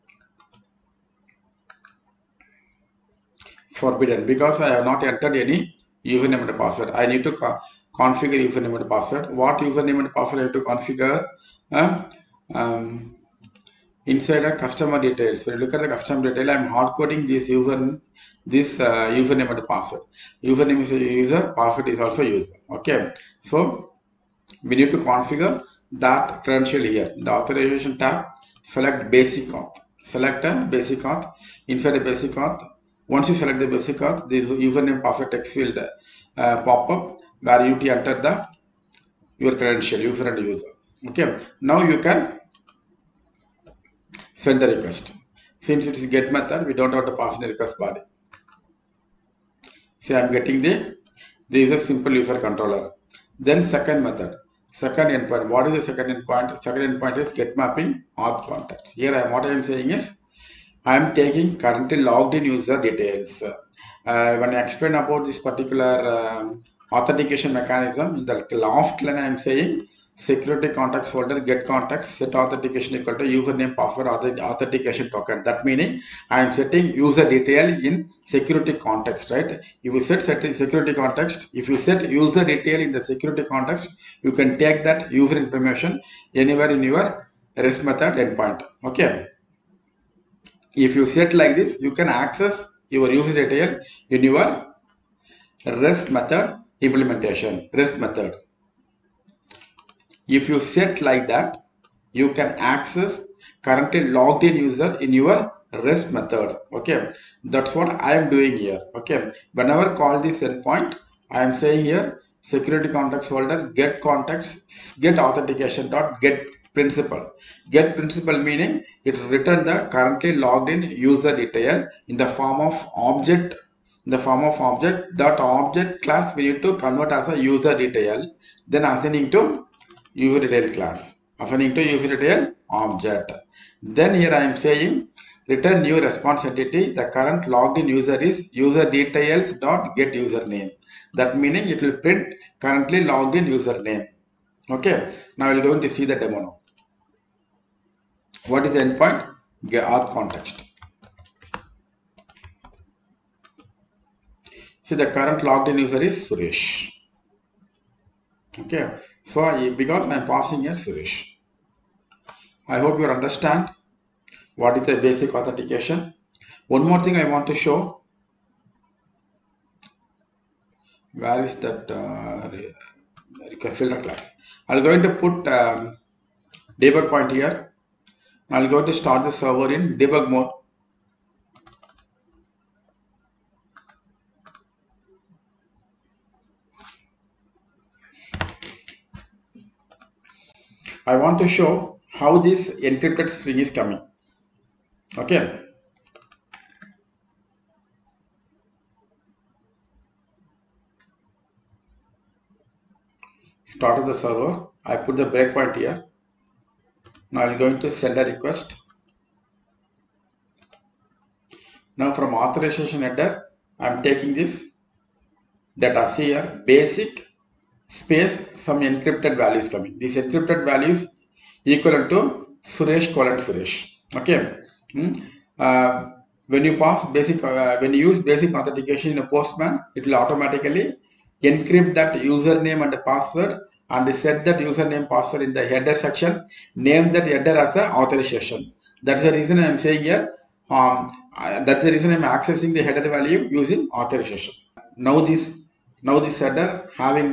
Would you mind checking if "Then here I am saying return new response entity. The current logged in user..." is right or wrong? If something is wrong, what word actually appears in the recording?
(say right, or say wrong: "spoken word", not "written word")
right.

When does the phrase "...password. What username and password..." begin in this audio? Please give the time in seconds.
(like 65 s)
8 s.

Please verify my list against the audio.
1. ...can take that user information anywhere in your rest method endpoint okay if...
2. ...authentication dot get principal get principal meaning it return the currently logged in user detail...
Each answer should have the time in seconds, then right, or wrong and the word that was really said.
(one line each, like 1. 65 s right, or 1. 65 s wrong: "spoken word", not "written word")
1. 84 s right
2. 115 s right.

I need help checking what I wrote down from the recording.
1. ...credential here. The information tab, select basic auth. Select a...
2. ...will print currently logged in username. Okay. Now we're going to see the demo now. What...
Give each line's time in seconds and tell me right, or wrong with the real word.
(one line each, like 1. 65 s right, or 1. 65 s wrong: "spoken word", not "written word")
1. 26 s wrong: "authorization", not "information"
2. 141 s right.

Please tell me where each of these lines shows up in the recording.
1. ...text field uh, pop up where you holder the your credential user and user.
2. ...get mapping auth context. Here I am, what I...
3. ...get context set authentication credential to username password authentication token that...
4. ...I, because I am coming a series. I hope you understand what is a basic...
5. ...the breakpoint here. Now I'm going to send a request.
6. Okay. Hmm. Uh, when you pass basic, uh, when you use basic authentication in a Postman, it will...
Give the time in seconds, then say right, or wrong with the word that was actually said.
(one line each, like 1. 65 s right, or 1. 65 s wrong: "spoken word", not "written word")
1. 35 s wrong: "enter", not "holder"
2. 57 s right
3. 71 s wrong: "equal", not "credential"
4. 159 s wrong: "passing", not "coming"
5. 205 s right
6. 224 s right.